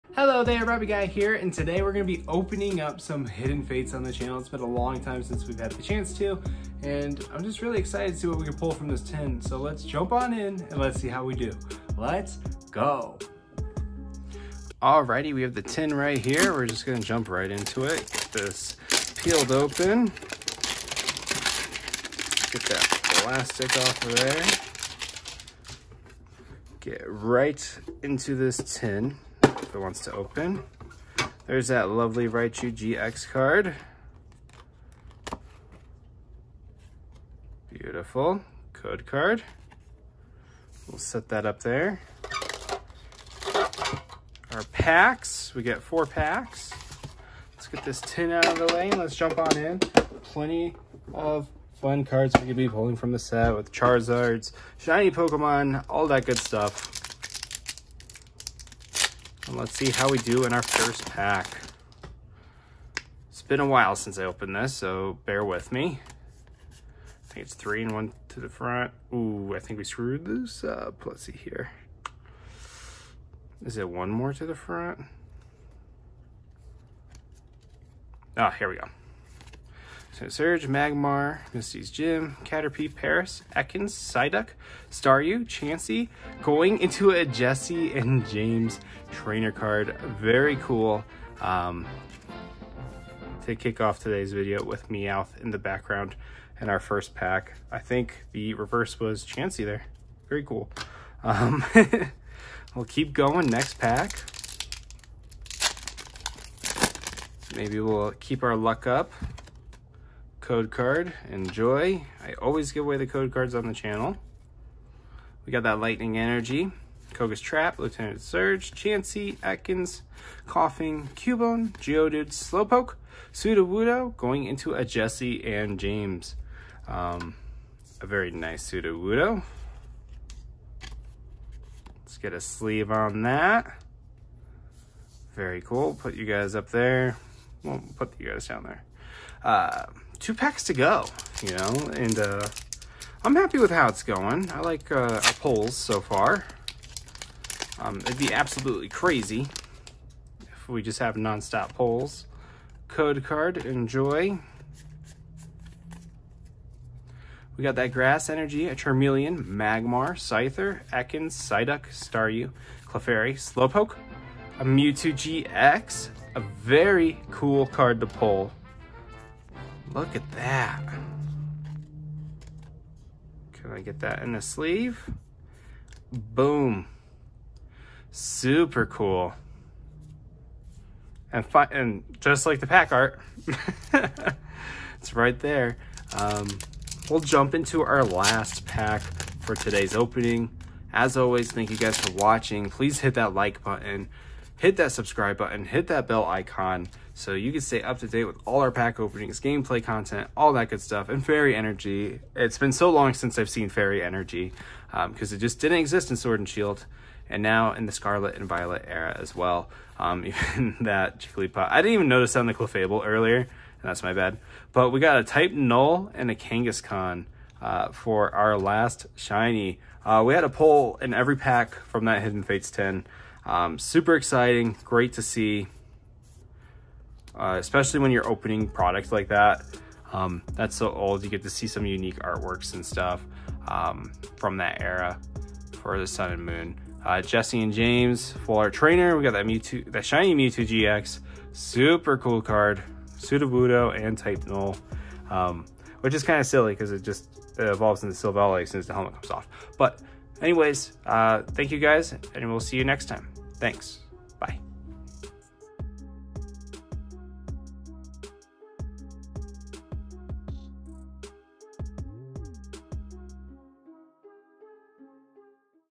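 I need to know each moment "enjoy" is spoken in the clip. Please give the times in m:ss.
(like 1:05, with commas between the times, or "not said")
1:51, 2:33.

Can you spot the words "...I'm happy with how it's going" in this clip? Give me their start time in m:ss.
2:23.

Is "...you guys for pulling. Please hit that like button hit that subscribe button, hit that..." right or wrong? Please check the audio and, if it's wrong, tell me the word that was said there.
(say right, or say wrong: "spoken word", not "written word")
wrong: "watching", not "pulling".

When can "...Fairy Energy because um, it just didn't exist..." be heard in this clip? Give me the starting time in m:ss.
3:23.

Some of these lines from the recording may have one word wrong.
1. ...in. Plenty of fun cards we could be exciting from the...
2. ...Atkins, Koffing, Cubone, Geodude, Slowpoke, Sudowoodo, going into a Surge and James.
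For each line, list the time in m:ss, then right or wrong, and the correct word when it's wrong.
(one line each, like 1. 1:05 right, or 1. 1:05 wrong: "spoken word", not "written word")
1. 0:49 wrong: "pulling", not "exciting"
2. 1:59 wrong: "Jessie", not "Surge".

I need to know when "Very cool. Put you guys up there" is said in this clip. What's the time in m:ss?
2:15.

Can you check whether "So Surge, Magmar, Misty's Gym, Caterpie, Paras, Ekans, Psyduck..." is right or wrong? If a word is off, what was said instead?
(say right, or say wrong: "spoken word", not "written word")
right.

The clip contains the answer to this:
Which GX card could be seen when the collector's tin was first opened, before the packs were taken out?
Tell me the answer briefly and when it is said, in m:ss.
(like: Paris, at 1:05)
Raichu GX, at 0:32.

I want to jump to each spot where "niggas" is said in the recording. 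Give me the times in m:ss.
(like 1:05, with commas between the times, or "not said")
not said.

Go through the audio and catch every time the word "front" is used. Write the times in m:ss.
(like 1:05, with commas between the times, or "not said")
1:08, 1:14.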